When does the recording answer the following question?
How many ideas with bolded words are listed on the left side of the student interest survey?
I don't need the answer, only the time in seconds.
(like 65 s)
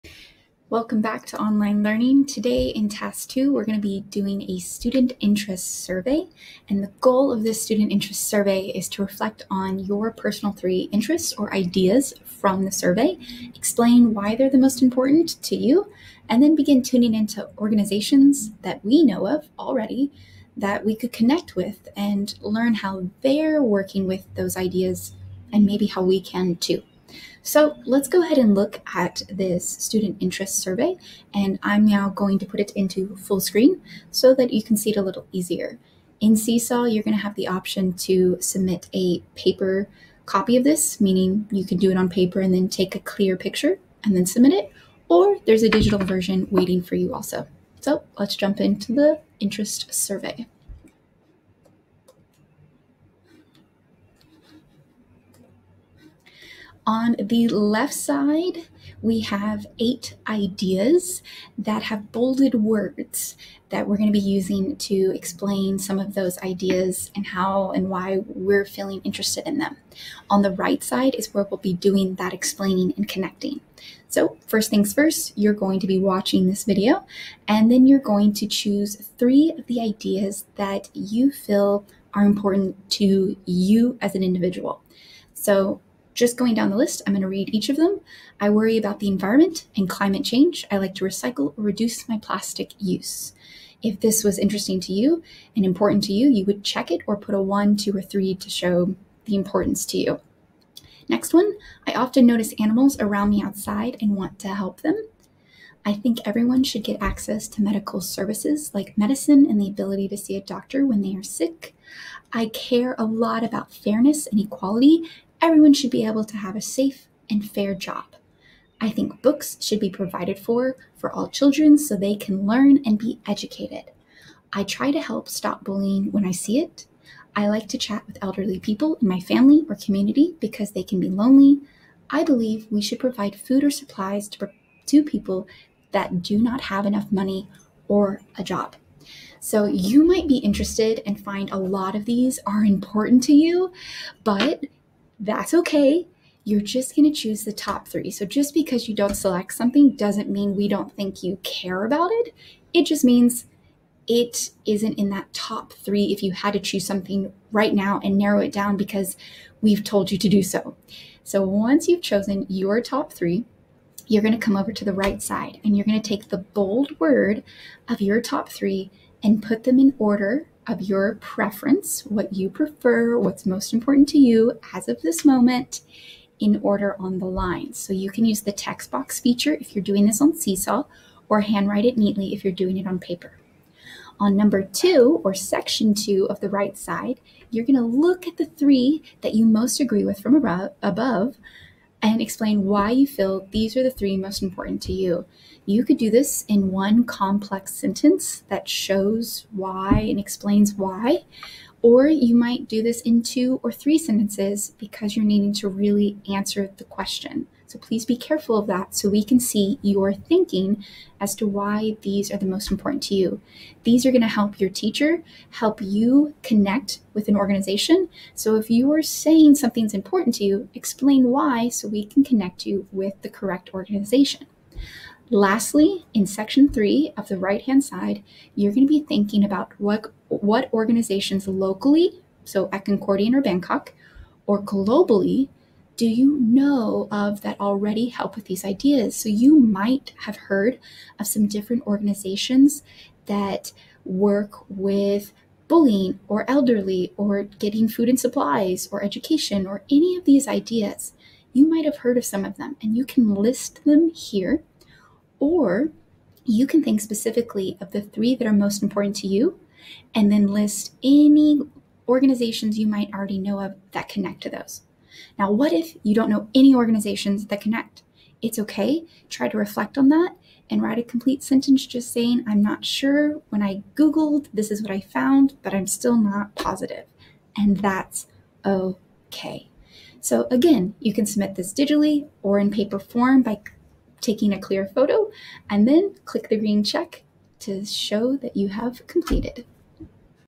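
59 s.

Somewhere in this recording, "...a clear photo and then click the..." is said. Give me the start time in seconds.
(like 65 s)
284 s.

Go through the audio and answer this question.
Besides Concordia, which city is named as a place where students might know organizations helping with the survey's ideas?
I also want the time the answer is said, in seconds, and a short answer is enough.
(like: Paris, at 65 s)
Bangkok, at 233 s.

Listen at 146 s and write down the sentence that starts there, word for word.
You're just going to choose the top three.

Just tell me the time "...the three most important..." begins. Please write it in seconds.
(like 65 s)
193 s.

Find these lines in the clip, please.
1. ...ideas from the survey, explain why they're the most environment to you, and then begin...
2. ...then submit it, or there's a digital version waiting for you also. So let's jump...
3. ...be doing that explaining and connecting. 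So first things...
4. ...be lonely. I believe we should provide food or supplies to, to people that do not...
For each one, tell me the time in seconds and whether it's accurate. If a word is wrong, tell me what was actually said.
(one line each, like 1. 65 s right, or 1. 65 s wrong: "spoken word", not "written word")
1. 11 s wrong: "important", not "environment"
2. 44 s right
3. 71 s right
4. 130 s right.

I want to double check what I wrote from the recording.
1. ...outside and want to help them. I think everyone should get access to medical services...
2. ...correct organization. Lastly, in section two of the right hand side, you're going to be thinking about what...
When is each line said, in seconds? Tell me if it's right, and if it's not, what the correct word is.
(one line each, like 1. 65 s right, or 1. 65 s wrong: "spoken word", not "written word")
1. 103 s right
2. 223 s wrong: "three", not "two".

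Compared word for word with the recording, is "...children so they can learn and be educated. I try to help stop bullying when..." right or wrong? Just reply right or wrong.
right.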